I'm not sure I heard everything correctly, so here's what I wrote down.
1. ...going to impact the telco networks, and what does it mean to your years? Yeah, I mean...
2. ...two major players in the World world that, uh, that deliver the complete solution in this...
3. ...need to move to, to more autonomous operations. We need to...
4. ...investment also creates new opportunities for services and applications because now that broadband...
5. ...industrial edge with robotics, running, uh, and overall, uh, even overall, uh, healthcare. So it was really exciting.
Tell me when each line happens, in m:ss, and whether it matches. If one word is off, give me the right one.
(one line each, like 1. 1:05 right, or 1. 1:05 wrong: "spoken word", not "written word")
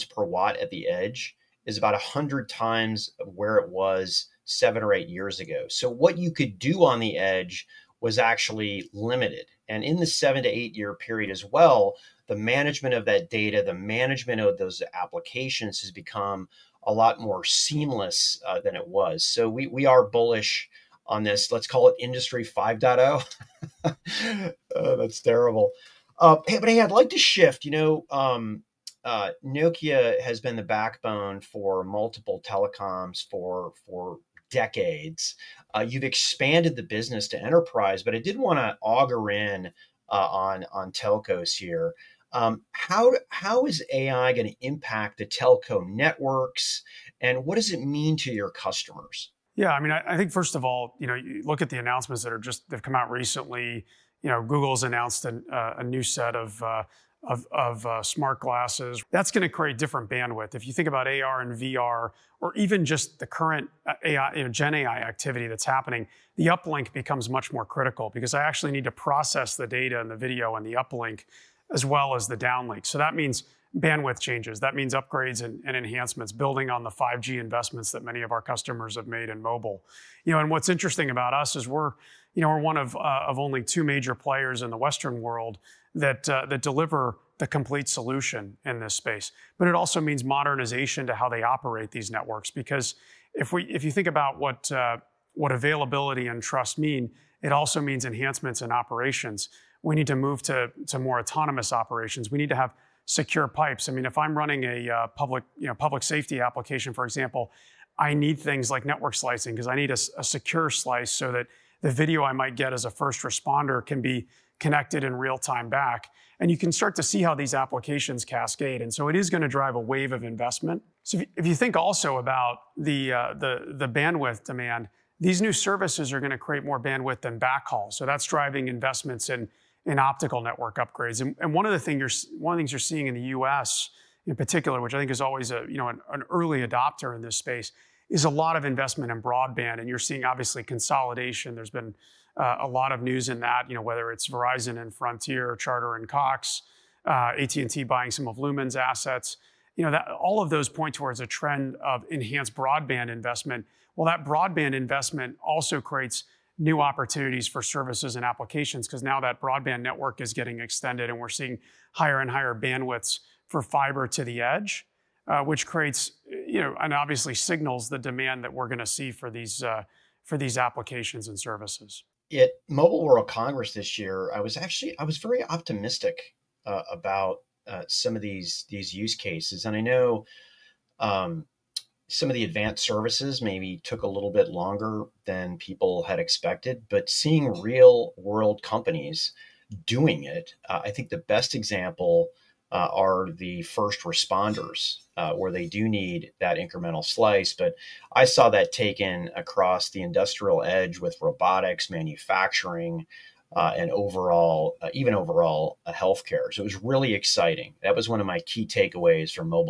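1. 0:44 wrong: "customers", not "years"
2. 1:23 wrong: "Western", not "World"
3. 1:39 right
4. 2:34 right
5. 3:20 wrong: "manufacturing", not "running".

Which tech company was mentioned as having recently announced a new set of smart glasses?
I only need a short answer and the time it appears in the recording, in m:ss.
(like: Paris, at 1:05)
Google, at 0:54.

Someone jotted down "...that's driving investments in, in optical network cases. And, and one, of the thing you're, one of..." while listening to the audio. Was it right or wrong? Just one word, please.
wrong.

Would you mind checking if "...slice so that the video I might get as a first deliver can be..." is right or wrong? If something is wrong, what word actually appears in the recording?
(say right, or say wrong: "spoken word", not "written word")
wrong: "responder", not "deliver".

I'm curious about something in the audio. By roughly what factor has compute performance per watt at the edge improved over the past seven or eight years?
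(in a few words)
100 times.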